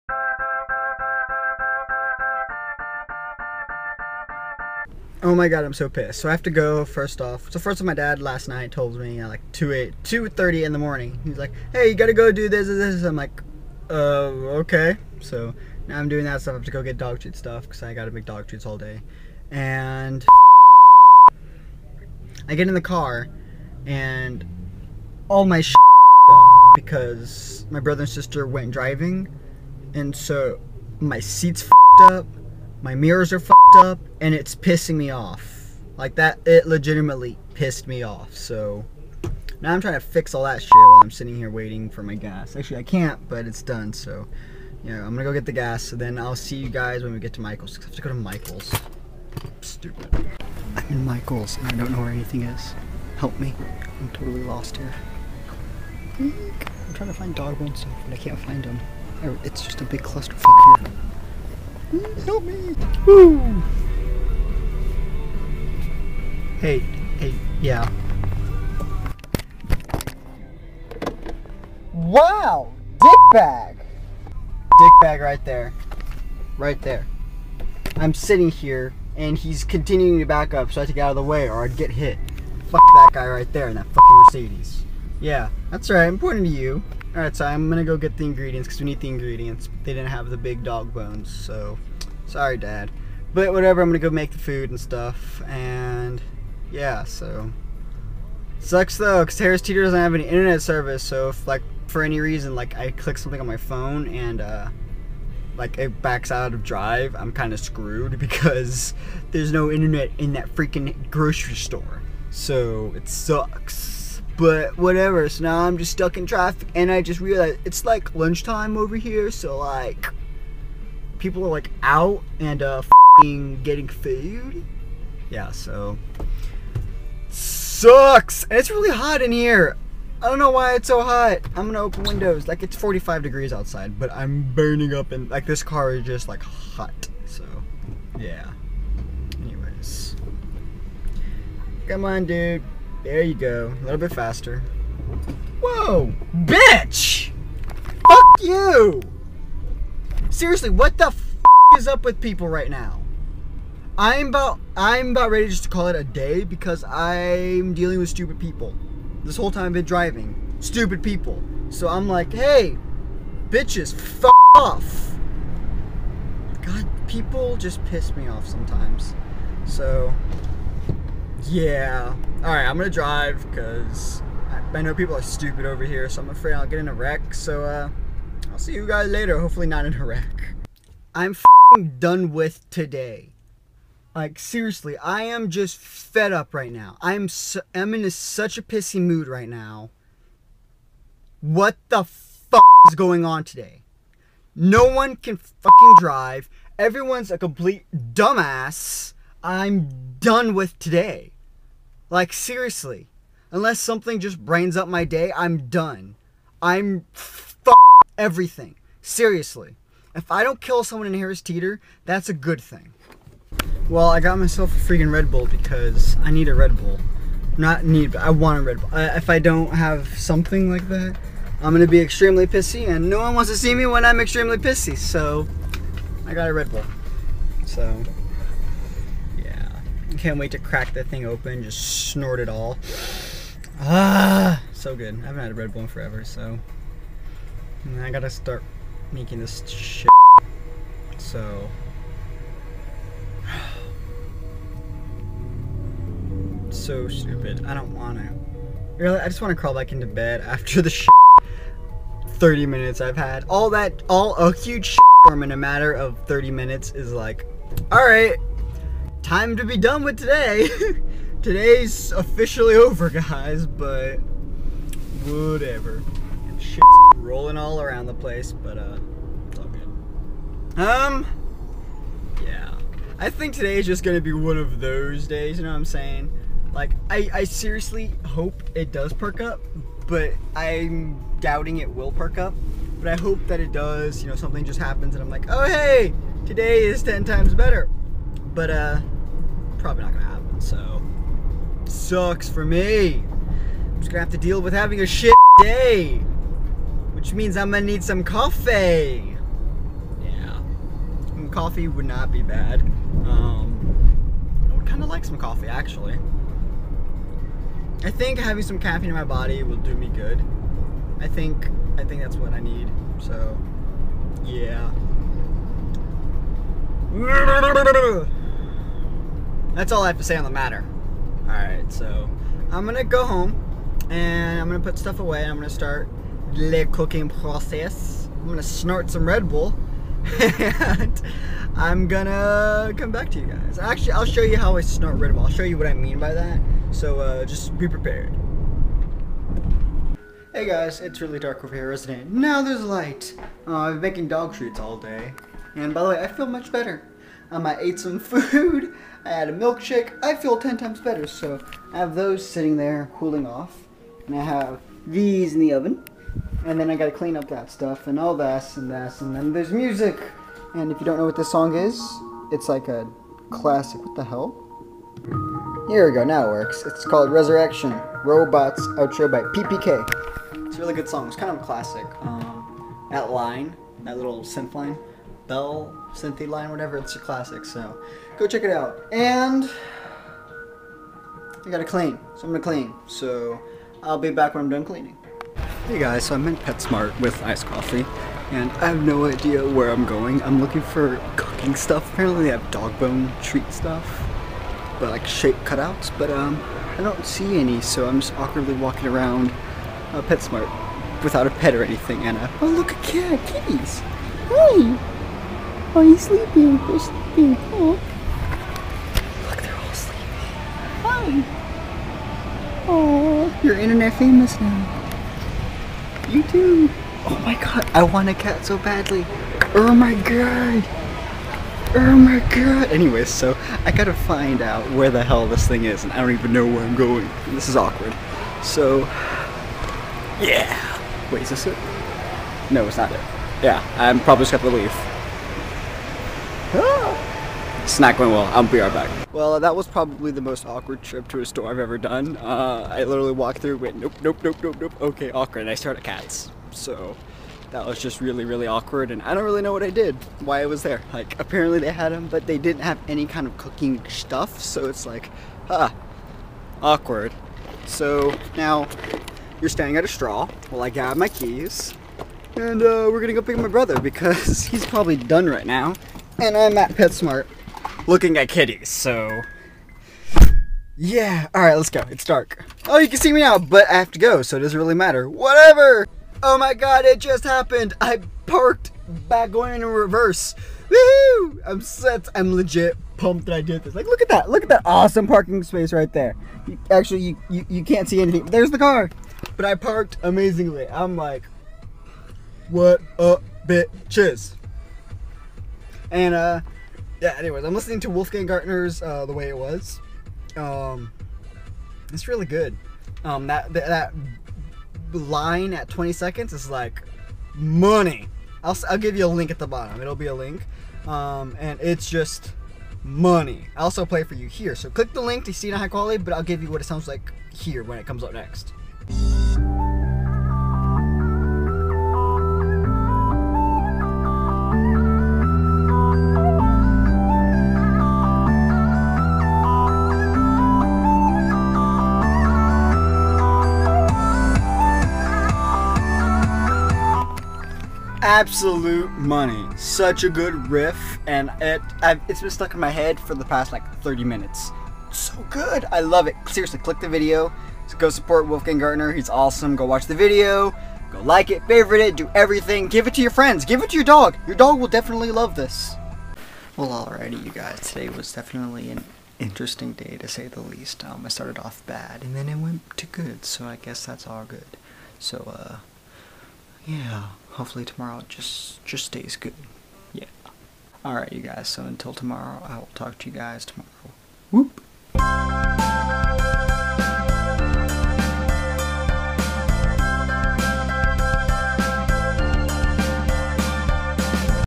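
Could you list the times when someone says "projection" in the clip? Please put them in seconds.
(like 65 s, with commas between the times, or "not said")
not said.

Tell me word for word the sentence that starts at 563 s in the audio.
So I guess that's all good.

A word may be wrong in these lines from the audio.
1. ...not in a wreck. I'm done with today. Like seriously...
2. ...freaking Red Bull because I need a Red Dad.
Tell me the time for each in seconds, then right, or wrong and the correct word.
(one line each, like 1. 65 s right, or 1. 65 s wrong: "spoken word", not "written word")
1. 179 s right
2. 214 s wrong: "Bull", not "Dad".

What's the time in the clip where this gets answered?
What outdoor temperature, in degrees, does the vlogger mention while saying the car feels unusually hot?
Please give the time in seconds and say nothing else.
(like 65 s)
132 s.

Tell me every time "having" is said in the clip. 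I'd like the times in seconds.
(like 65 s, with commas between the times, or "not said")
294 s, 308 s.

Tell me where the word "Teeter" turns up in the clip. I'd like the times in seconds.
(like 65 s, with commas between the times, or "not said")
99 s, 211 s.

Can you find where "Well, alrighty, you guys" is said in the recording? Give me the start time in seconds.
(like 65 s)
556 s.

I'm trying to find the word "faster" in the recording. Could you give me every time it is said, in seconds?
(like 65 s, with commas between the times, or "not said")
144 s.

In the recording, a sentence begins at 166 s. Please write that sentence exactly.
God, people just piss me off sometimes.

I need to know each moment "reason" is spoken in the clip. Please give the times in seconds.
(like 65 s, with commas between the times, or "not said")
102 s.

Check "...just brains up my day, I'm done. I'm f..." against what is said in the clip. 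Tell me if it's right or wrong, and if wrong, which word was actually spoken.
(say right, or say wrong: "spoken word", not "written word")
right.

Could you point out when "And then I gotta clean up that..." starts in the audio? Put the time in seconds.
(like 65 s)
356 s.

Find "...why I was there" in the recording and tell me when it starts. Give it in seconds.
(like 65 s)
450 s.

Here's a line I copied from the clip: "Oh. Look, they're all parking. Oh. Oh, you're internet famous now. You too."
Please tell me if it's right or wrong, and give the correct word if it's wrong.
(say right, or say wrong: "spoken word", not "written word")
wrong: "sleeping", not "parking".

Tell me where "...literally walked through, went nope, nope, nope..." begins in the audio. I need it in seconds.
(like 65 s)
443 s.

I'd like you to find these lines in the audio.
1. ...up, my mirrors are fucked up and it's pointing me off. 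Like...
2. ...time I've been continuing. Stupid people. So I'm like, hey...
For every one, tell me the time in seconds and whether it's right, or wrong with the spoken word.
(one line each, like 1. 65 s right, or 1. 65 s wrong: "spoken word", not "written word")
1. 32 s wrong: "pissing", not "pointing"
2. 159 s wrong: "driving", not "continuing".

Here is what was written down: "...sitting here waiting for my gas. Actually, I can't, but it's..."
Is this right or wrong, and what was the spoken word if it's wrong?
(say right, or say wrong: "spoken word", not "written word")
right.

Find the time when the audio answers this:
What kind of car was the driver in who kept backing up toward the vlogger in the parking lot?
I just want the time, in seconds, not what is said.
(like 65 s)
84 s.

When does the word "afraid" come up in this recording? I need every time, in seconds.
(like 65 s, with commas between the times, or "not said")
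176 s.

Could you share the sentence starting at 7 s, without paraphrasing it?
So first of my dad last night told me at like 2 8 2 30 in the morning.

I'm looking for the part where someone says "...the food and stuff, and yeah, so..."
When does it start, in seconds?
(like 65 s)
94 s.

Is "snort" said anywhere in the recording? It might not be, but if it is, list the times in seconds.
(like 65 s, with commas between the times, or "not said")
232 s, 328 s, 334 s.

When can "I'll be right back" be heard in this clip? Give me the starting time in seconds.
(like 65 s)
438 s.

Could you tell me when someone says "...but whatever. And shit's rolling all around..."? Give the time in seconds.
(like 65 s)
263 s.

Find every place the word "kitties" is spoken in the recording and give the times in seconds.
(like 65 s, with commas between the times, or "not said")
403 s, 468 s.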